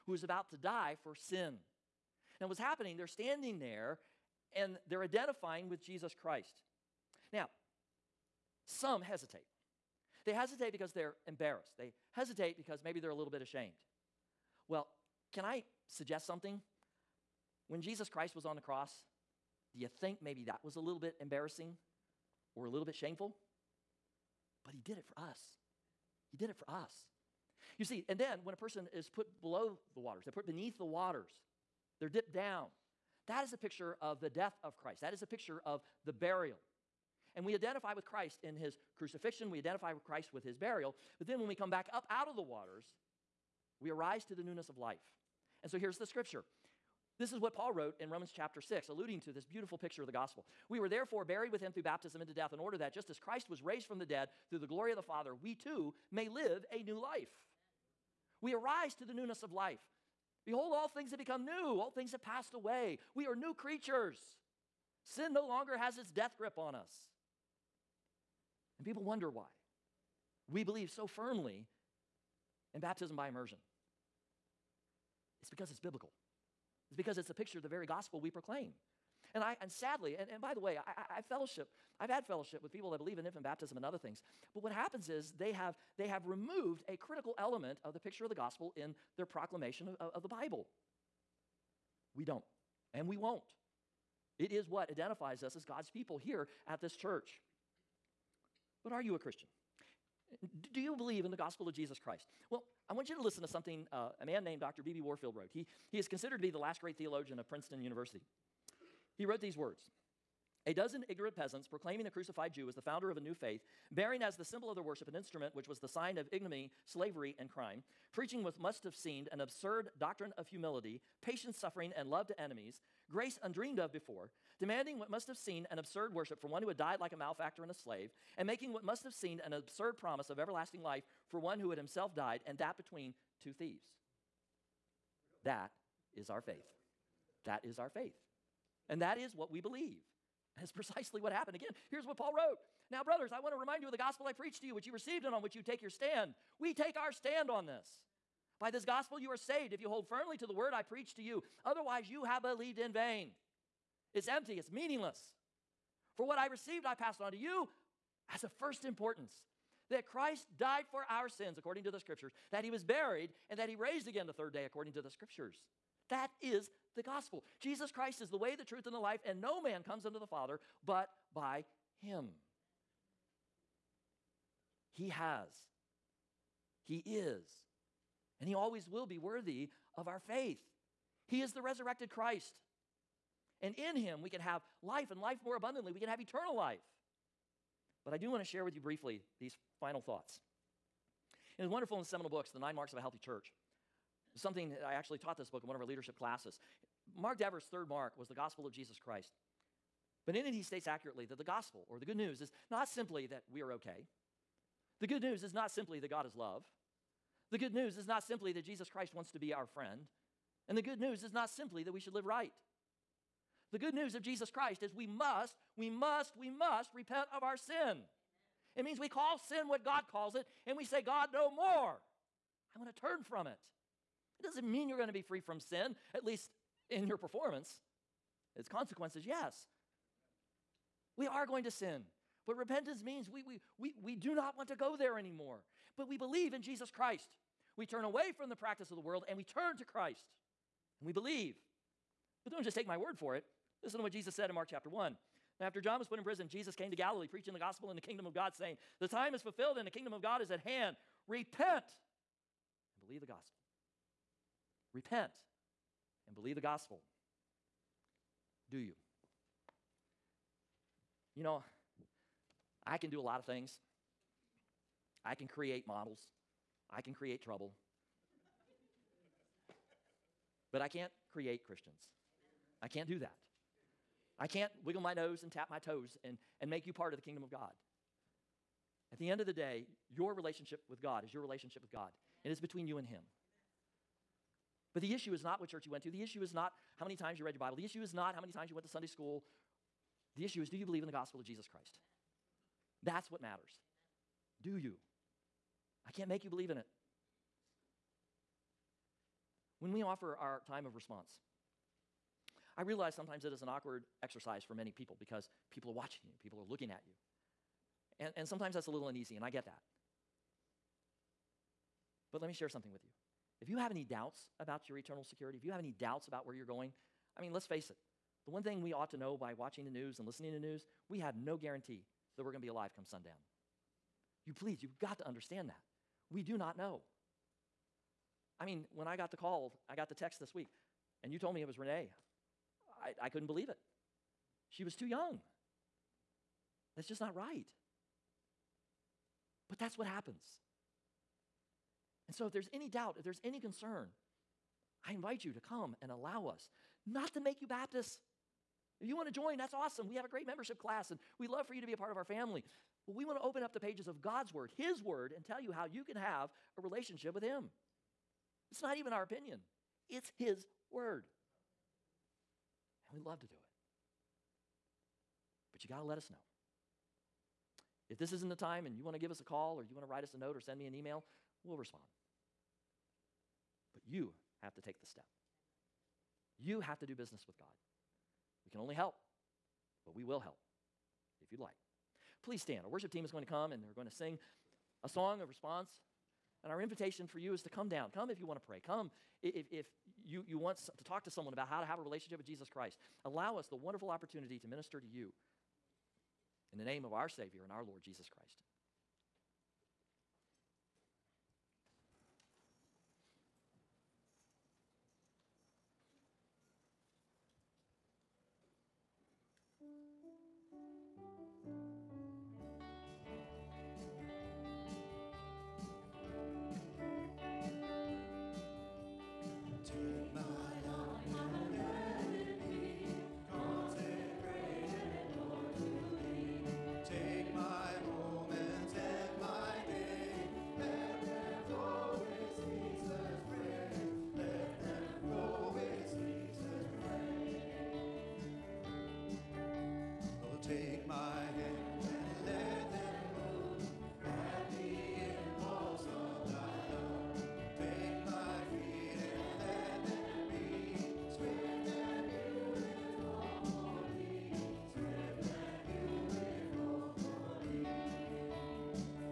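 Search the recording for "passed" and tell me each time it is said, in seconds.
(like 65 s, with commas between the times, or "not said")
62 s, 156 s.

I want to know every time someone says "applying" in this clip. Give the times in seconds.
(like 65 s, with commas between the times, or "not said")
not said.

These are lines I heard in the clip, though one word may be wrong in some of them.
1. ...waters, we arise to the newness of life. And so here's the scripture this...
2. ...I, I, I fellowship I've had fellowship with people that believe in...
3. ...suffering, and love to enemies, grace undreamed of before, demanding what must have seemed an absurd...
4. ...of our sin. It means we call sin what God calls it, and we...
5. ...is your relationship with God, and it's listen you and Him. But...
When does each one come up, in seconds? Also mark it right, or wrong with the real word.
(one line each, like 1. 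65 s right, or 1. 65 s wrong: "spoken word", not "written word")
1. 42 s right
2. 80 s right
3. 121 s right
4. 217 s right
5. 281 s wrong: "between", not "listen".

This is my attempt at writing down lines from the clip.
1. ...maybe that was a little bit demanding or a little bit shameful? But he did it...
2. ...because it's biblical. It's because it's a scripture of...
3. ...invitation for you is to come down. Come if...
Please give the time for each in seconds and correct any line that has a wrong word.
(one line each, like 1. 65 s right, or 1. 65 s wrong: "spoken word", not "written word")
1. 20 s wrong: "embarrassing", not "demanding"
2. 75 s wrong: "picture", not "scripture"
3. 386 s right.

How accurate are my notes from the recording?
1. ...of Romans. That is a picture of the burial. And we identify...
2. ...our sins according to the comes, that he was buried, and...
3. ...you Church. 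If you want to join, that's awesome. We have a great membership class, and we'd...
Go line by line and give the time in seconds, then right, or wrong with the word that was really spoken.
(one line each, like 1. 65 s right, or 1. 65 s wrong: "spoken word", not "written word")
1. 34 s wrong: "Christ", not "Romans"
2. 161 s wrong: "scriptures", not "comes"
3. 347 s wrong: "Baptists", not "Church".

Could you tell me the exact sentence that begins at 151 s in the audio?
Otherwise, you have believed in vain.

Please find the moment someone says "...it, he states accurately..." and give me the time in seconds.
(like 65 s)
200 s.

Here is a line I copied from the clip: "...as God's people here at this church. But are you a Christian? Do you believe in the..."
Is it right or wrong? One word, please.
right.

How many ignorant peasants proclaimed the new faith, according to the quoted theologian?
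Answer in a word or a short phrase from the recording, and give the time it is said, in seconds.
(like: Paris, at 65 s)
12, at 110 s.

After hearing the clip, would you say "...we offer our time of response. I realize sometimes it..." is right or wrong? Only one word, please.
right.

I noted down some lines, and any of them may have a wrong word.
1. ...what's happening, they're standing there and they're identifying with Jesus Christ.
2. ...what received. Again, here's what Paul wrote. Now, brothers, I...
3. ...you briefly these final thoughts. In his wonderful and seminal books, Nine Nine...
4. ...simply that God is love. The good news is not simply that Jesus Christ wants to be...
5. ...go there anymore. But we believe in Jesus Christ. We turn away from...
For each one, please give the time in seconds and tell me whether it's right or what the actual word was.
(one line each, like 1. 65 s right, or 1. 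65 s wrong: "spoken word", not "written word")
1. 2 s right
2. 141 s wrong: "happened", not "received"
3. 188 s wrong: "The", not "Nine"
4. 205 s right
5. 234 s right.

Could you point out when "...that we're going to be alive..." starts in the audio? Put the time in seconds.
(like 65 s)
322 s.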